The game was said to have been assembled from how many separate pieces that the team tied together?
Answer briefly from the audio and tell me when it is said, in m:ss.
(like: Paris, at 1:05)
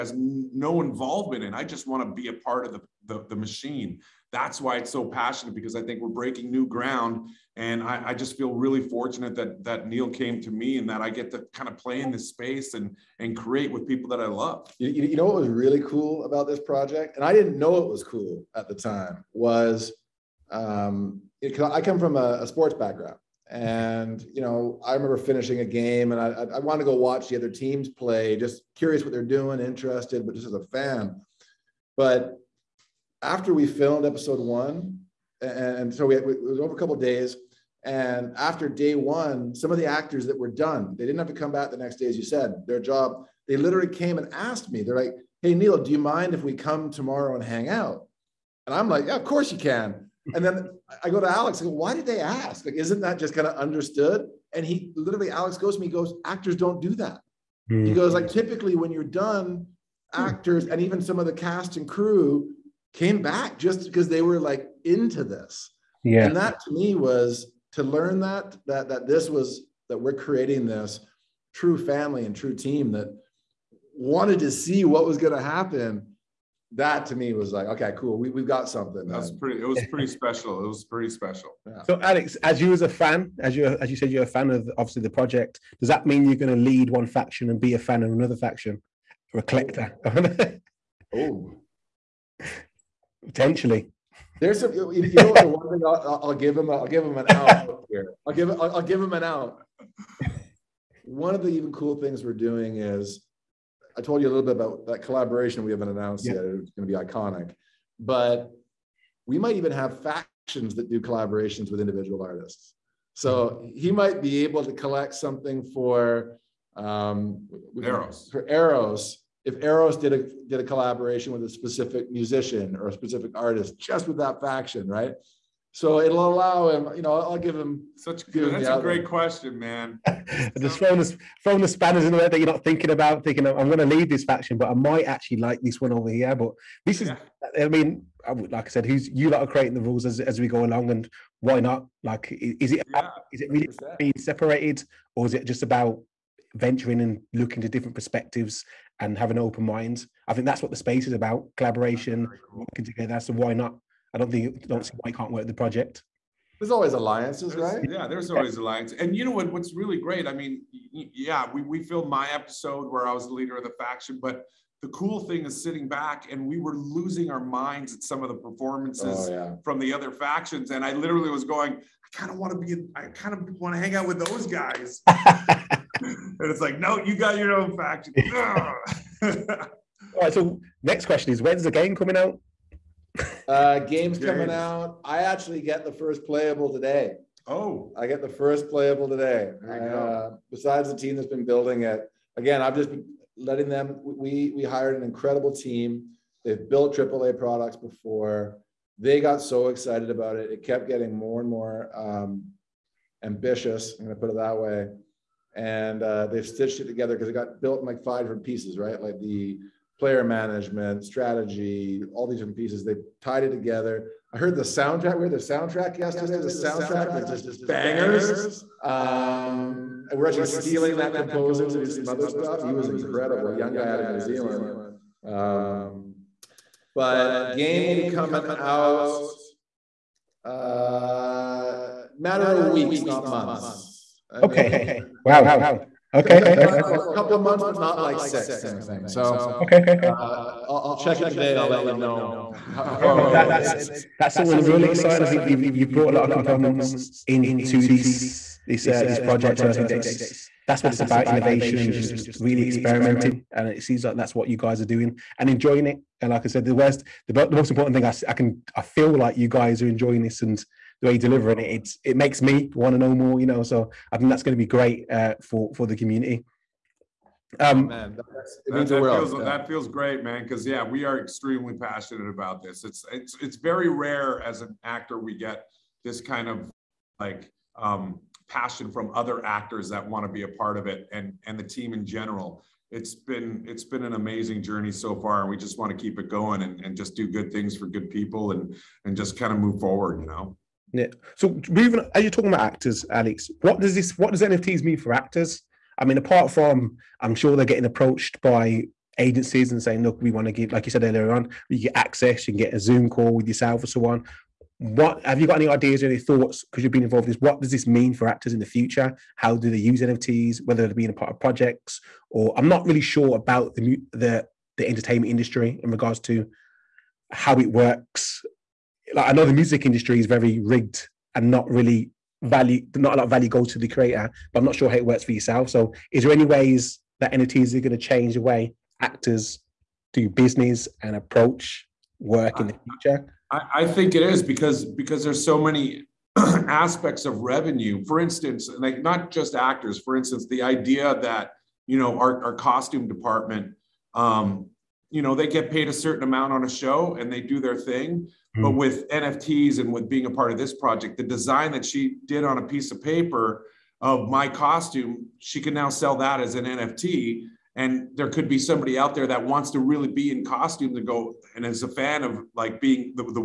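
5, at 3:28.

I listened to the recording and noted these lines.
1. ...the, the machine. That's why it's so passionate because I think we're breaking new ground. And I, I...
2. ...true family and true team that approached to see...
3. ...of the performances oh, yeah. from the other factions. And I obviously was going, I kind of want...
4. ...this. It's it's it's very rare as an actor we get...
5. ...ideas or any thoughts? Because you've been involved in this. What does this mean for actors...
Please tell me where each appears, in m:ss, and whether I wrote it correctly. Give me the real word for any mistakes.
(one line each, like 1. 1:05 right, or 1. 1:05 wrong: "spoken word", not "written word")
1. 0:03 right
2. 1:11 wrong: "wanted", not "approached"
3. 2:48 wrong: "literally", not "obviously"
4. 4:32 right
5. 5:05 right.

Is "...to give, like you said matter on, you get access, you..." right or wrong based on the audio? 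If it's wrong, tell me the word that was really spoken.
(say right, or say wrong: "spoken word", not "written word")
wrong: "earlier", not "matter".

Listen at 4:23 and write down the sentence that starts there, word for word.
You know, so I think that's going to be great uh, for for the community.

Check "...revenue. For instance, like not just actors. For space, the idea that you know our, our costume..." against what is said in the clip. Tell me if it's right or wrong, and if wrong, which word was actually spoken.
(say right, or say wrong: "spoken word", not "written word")
wrong: "instance", not "space".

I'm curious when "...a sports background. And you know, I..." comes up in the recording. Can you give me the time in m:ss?
0:22.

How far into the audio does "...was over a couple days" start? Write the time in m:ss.
0:36.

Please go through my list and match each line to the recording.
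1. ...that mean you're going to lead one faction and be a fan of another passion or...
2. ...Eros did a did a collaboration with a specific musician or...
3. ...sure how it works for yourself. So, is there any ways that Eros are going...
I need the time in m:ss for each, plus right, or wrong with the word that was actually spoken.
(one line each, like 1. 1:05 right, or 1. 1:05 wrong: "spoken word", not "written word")
1. 1:25 wrong: "faction", not "passion"
2. 1:59 right
3. 5:24 wrong: "NFTs", not "Eros".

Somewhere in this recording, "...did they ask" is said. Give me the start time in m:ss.
0:51.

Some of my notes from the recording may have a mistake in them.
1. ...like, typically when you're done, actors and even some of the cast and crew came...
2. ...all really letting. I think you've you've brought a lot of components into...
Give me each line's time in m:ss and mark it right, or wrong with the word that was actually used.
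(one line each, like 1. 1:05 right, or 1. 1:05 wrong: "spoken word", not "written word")
1. 0:58 right
2. 4:04 wrong: "exciting", not "letting".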